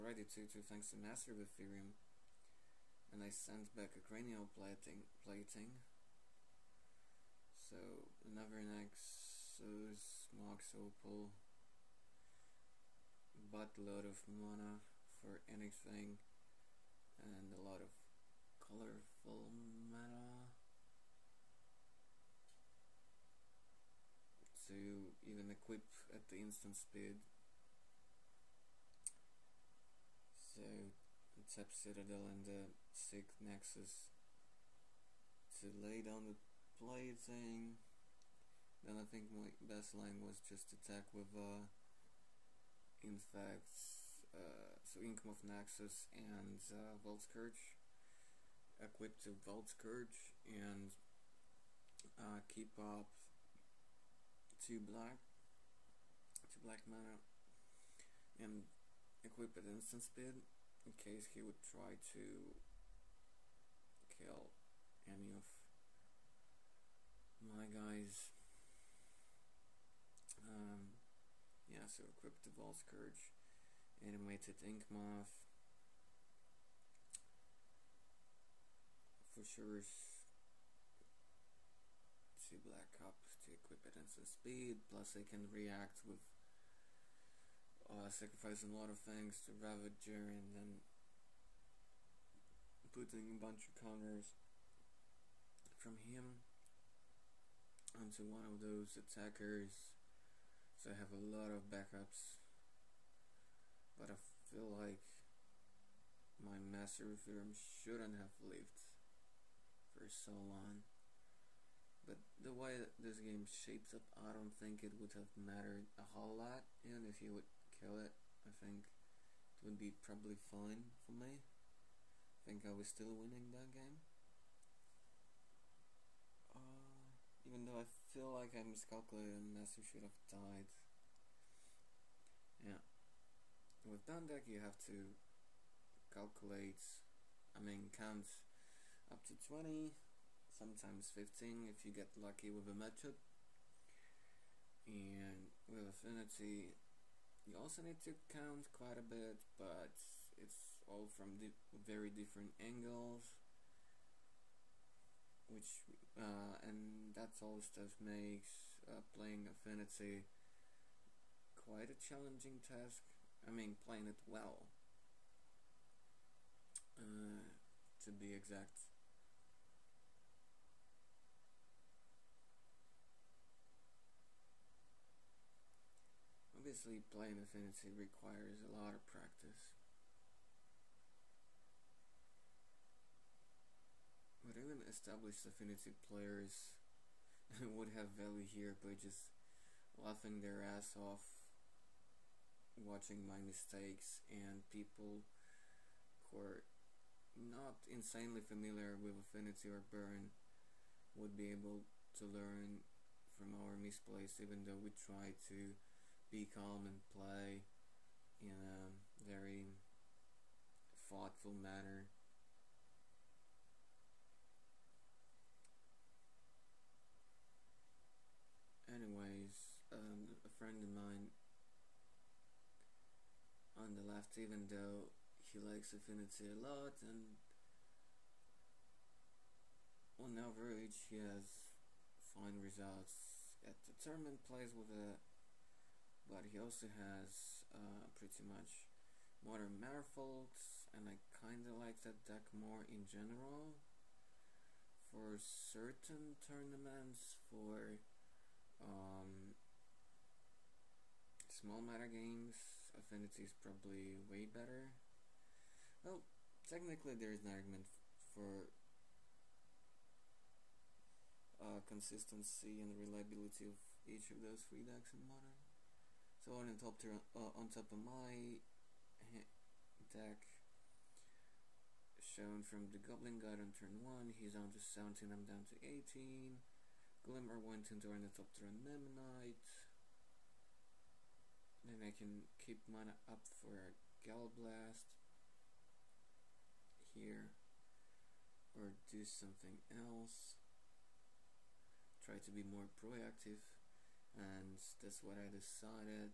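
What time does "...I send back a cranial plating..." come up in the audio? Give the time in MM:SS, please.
00:03.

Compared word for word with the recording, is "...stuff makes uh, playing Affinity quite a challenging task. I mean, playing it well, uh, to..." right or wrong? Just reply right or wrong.
right.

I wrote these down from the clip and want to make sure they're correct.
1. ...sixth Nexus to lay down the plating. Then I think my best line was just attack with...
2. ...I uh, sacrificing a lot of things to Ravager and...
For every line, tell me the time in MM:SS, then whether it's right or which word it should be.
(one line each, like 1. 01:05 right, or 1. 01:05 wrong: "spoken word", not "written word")
1. 00:32 right
2. 01:27 right.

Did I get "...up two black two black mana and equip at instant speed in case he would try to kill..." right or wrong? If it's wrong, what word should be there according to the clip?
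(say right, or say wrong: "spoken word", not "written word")
right.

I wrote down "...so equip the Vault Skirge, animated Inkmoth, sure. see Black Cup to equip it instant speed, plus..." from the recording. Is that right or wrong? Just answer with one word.
right.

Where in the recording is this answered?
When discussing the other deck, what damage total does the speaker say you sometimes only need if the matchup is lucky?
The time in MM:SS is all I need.
02:21.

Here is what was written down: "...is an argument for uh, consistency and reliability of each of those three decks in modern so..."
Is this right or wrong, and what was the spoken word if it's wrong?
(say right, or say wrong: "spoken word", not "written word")
right.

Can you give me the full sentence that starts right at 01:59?
It would be probably fine for me.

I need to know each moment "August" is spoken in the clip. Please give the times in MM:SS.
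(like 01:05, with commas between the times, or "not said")
not said.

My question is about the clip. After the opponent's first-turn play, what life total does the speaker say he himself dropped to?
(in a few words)
18.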